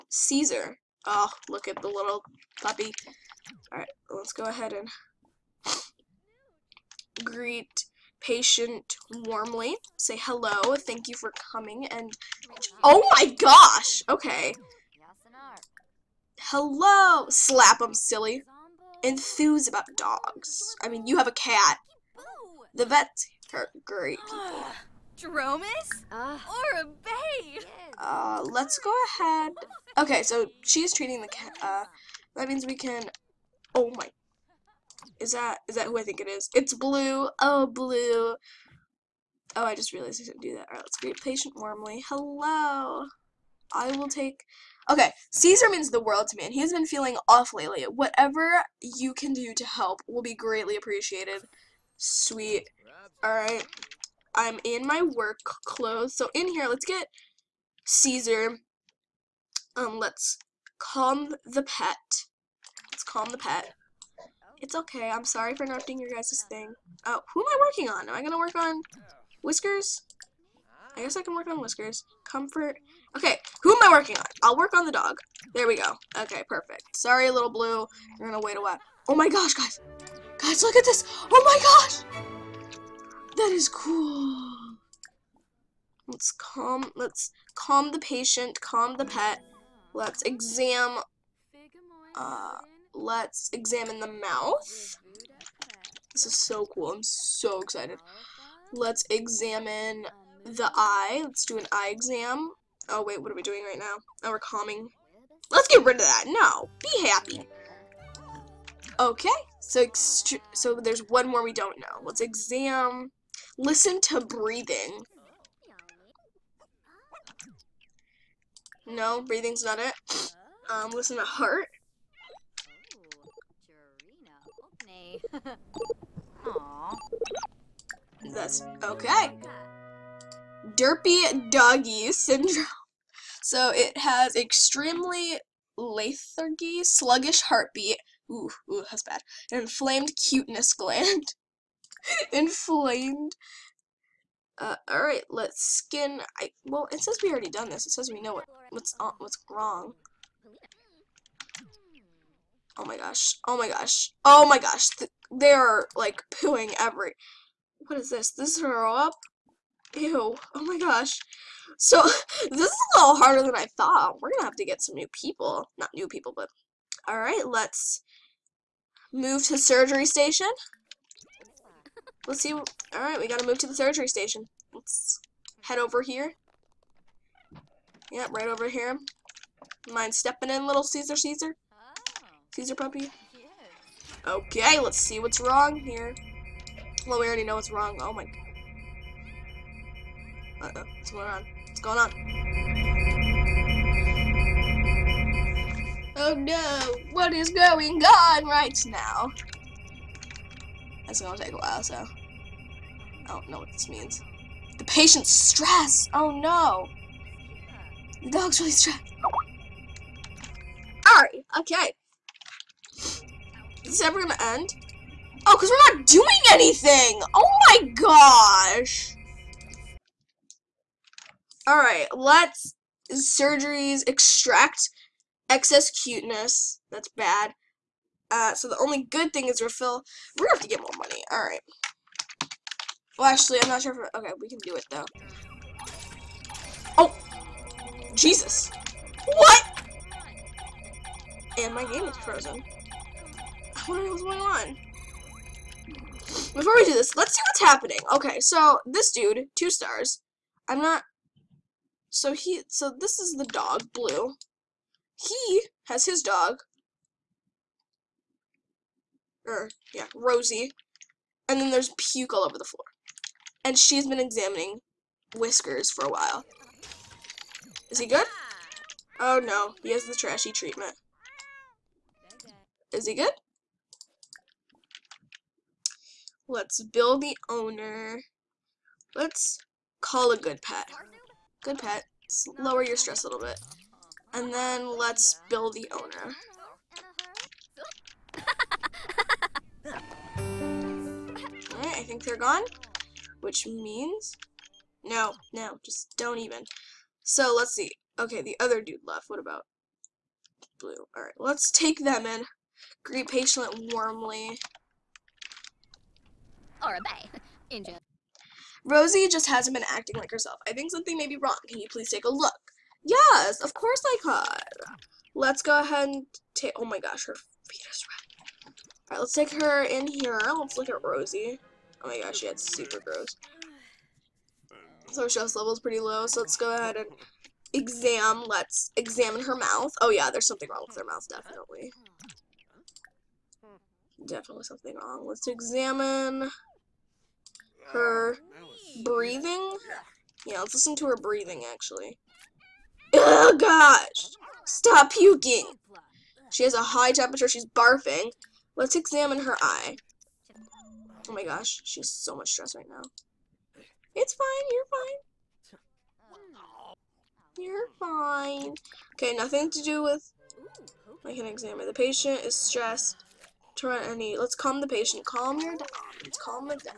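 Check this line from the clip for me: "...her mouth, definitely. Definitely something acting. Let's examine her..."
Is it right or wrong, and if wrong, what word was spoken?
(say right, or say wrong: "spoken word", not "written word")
wrong: "wrong", not "acting".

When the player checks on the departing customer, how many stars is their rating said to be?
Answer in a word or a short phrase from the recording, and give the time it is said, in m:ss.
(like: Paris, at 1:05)
2, at 4:09.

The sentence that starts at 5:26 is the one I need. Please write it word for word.
So let's go ahead and exam.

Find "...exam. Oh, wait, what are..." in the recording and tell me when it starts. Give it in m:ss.
1:41.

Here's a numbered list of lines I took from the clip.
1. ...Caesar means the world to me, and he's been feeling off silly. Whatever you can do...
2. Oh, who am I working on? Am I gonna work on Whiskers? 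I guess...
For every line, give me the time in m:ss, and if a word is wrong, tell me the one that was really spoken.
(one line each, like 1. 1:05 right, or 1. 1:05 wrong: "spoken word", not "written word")
1. 0:45 wrong: "lately", not "silly"
2. 1:07 right.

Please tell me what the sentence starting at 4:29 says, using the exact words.
Oh no, he has the trashy treatment.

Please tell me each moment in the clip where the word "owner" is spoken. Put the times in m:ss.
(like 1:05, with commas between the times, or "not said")
4:37, 4:45.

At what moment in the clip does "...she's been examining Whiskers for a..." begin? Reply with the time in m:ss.
4:23.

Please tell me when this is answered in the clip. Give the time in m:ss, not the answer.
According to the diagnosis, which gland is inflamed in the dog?
2:19.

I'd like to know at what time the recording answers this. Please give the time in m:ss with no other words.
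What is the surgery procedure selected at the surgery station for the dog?
3:44.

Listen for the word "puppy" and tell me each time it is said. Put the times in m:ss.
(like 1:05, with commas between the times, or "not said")
0:02, 3:02.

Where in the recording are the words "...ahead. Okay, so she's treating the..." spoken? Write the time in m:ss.
0:29.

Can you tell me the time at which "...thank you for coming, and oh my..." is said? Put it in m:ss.
0:10.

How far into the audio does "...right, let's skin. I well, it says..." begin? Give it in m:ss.
2:25.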